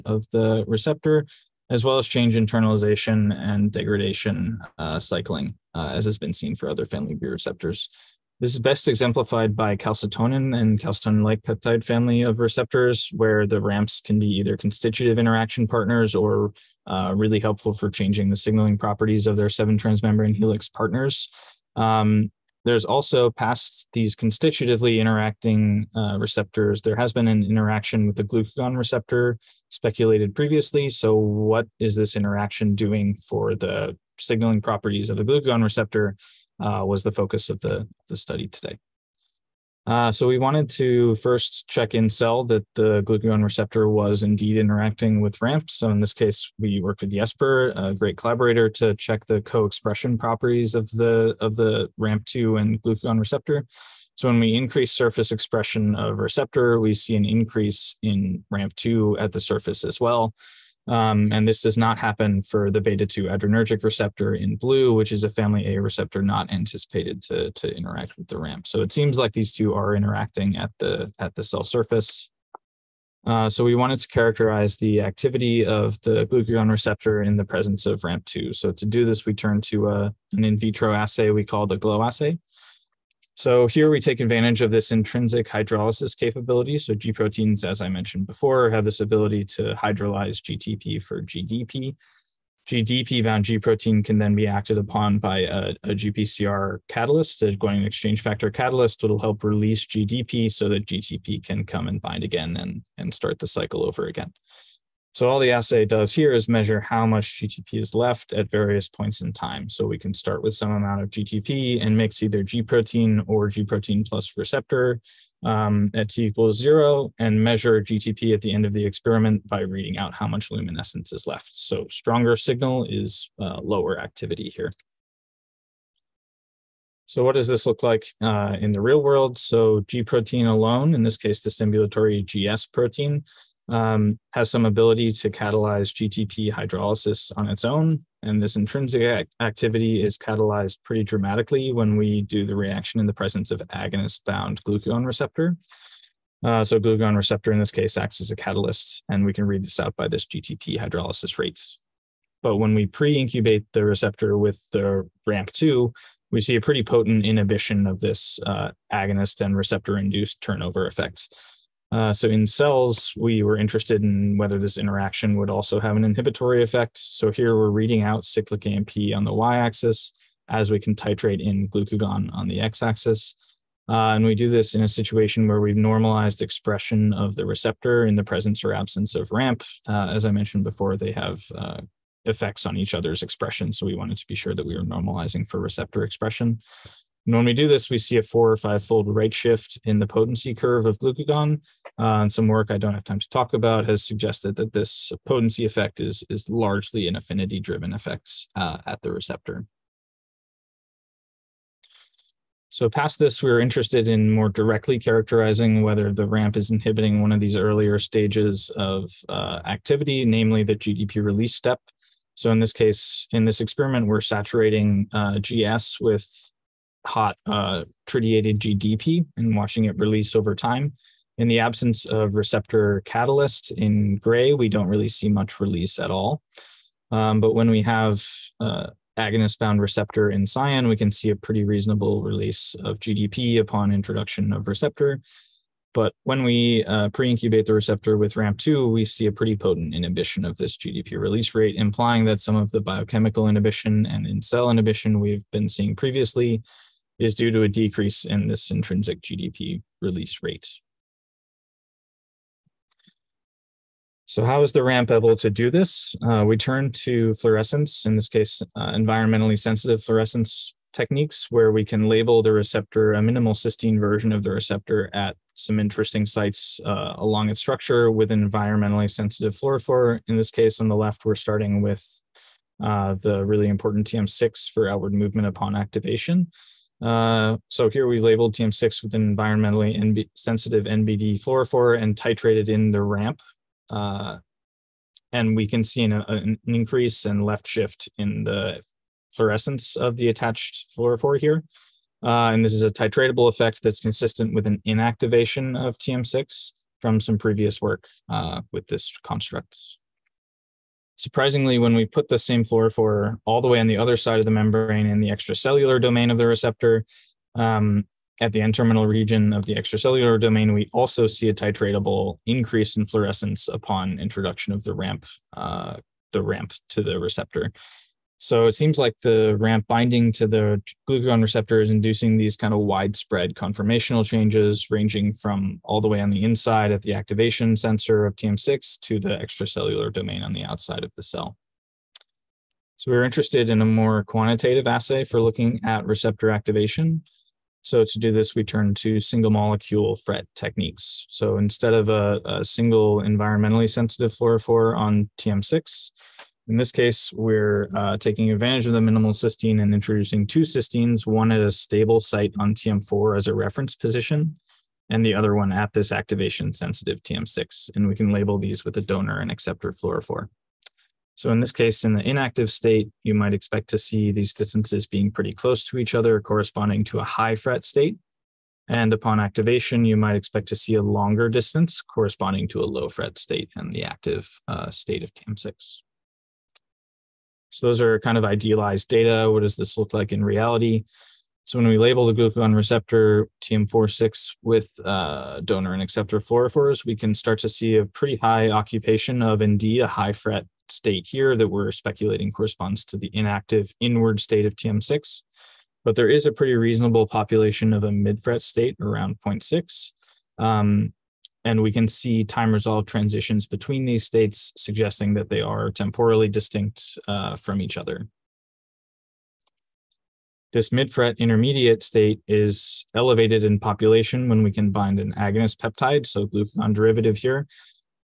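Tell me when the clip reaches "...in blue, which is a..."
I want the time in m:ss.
1:04.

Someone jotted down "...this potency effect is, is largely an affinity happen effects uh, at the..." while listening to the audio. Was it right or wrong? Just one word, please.
wrong.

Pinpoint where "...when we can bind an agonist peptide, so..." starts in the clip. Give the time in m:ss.
6:54.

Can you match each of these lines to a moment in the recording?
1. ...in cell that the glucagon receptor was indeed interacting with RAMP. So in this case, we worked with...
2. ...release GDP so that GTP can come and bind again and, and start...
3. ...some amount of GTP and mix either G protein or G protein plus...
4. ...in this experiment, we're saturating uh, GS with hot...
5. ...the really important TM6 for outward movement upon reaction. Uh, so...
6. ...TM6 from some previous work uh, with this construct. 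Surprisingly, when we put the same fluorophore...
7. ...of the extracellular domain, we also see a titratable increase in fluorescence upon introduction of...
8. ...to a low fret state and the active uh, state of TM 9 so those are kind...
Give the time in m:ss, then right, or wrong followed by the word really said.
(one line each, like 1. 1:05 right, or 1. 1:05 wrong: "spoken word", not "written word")
1. 0:41 right
2. 1:39 right
3. 1:50 right
4. 3:33 right
5. 4:33 wrong: "activation", not "reaction"
6. 4:55 right
7. 5:09 right
8. 6:12 wrong: "6", not "9".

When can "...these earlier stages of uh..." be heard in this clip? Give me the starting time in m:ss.
3:27.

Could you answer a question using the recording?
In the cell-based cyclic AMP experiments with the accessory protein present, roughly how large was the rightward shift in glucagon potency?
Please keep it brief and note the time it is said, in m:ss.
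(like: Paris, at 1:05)
4 or 5 fold, at 3:08.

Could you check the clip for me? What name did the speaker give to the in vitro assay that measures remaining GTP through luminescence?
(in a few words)
GLOW assay.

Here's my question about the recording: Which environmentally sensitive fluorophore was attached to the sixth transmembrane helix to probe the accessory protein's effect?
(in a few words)
NBD.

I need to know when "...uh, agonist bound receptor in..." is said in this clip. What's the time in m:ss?
3:48.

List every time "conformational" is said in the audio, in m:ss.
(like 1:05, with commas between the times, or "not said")
5:23.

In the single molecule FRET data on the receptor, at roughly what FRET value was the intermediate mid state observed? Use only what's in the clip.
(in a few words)
0.6.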